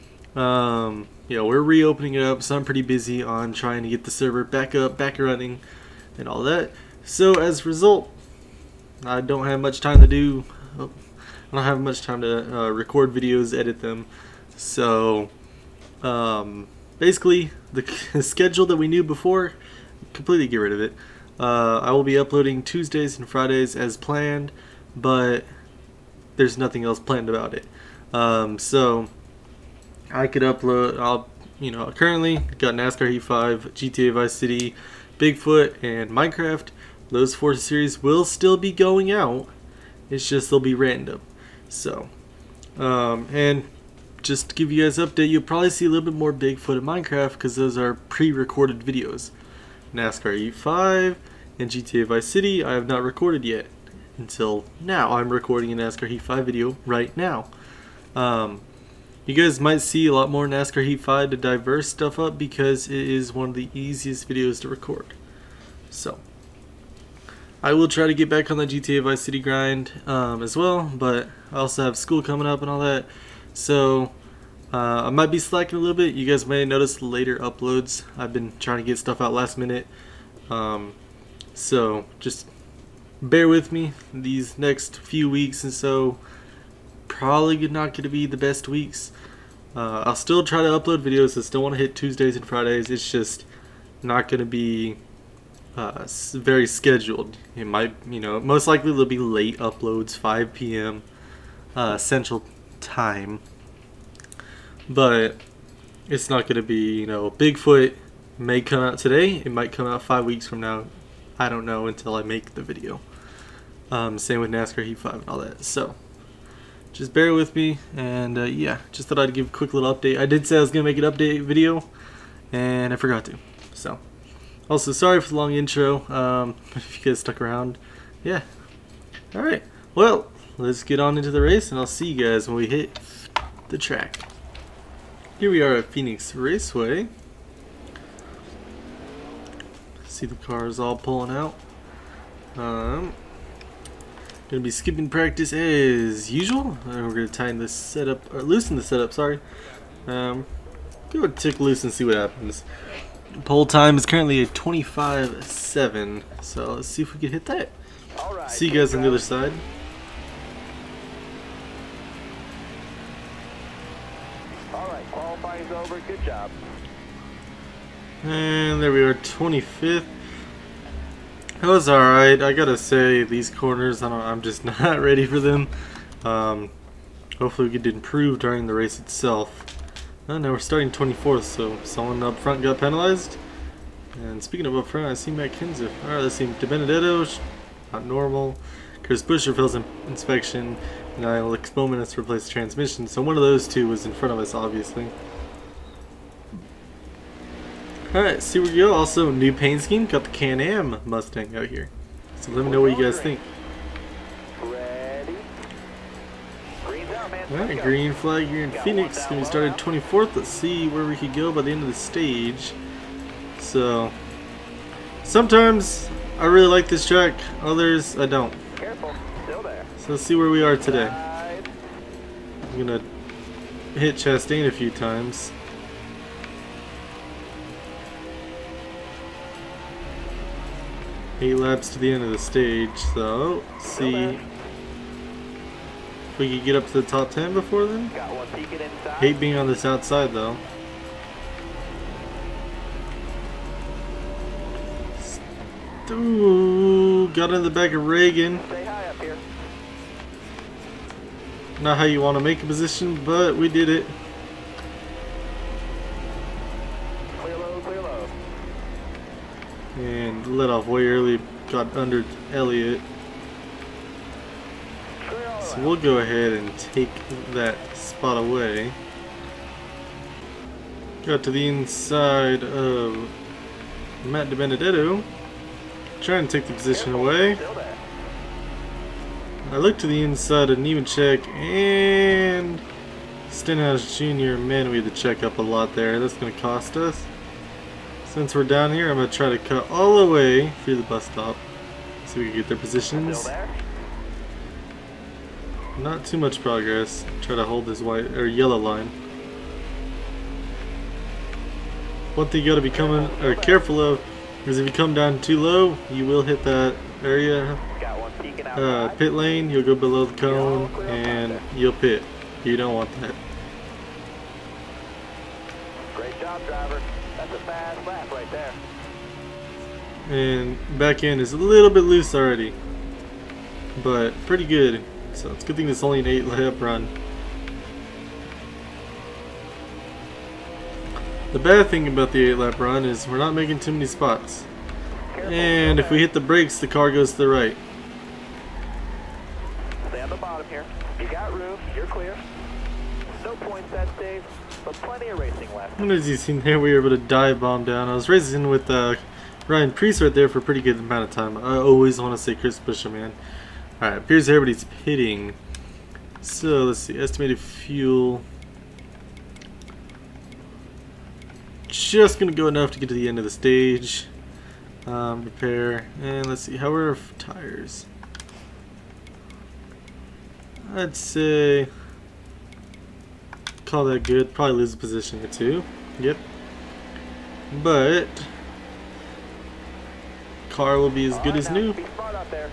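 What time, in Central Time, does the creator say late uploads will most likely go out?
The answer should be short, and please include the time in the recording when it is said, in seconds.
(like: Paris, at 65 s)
5 p.m., at 100 s.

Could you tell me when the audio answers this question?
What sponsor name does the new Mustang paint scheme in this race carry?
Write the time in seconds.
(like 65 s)
200 s.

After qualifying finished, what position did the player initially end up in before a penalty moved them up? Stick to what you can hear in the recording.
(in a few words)
25th.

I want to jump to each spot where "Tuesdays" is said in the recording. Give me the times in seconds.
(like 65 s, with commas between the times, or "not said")
22 s, 91 s.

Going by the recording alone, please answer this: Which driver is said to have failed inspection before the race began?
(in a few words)
Chris Buescher.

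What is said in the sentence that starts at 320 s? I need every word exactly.
And back end is a little bit loose already, but pretty good.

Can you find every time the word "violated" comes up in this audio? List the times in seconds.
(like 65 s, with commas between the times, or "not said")
not said.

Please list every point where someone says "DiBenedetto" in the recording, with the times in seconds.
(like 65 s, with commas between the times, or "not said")
186 s, 274 s.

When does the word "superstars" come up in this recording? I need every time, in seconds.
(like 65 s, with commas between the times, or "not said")
not said.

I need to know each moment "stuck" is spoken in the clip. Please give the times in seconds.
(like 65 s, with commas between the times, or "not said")
127 s.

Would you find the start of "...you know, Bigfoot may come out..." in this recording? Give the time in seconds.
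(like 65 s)
107 s.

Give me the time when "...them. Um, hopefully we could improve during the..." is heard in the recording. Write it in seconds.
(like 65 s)
175 s.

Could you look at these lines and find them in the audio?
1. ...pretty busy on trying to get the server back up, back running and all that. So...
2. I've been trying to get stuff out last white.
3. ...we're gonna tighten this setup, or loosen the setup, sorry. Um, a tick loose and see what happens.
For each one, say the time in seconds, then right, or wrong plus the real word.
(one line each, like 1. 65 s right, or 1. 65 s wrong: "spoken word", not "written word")
1. 2 s right
2. 78 s wrong: "minute", not "white"
3. 147 s right.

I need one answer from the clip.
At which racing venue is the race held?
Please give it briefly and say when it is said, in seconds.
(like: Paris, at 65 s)
Phoenix Raceway, at 135 s.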